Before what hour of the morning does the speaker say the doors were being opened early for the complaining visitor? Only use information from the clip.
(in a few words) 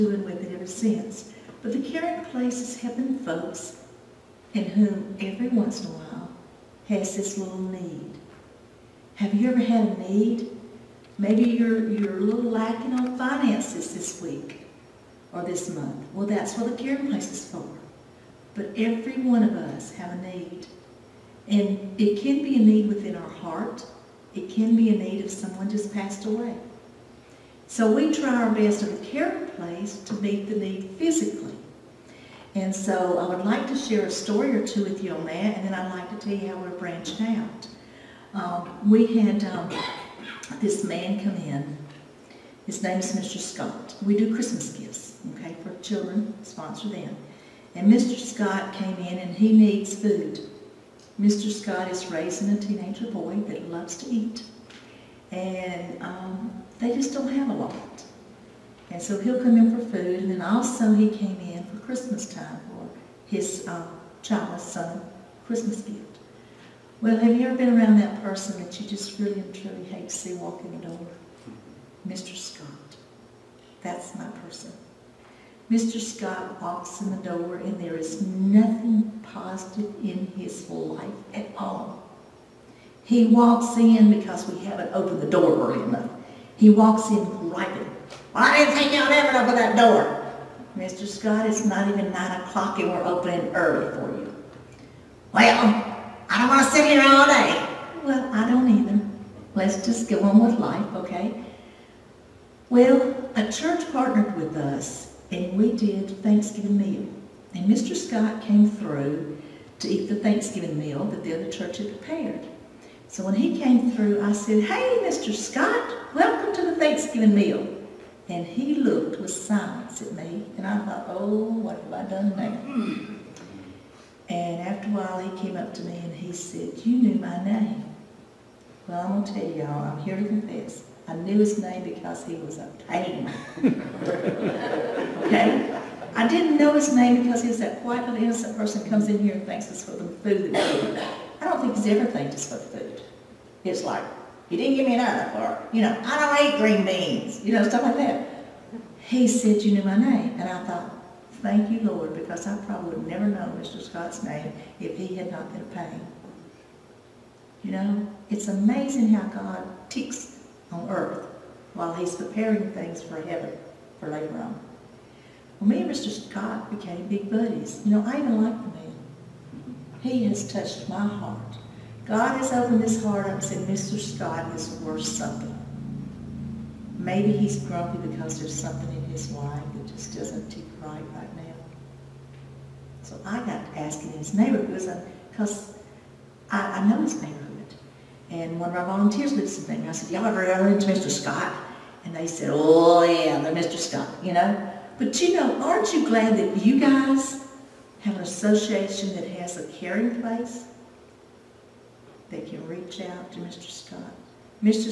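9 o'clock.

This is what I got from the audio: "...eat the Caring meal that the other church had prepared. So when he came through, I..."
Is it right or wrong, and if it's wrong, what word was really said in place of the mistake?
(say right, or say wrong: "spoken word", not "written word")
wrong: "Thanksgiving", not "Caring".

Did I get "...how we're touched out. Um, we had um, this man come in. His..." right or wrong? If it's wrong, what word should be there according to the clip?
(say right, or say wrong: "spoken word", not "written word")
wrong: "branched", not "touched".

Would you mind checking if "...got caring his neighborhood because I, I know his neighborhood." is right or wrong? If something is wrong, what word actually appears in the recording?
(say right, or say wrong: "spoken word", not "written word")
wrong: "asking", not "caring".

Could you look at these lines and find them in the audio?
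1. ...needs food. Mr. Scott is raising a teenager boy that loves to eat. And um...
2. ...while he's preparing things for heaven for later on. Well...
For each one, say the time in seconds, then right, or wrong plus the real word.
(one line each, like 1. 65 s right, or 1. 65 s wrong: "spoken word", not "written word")
1. 49 s right
2. 161 s right.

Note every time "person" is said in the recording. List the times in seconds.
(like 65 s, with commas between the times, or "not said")
68 s, 74 s, 138 s.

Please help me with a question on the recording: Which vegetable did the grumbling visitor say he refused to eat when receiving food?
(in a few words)
green beans.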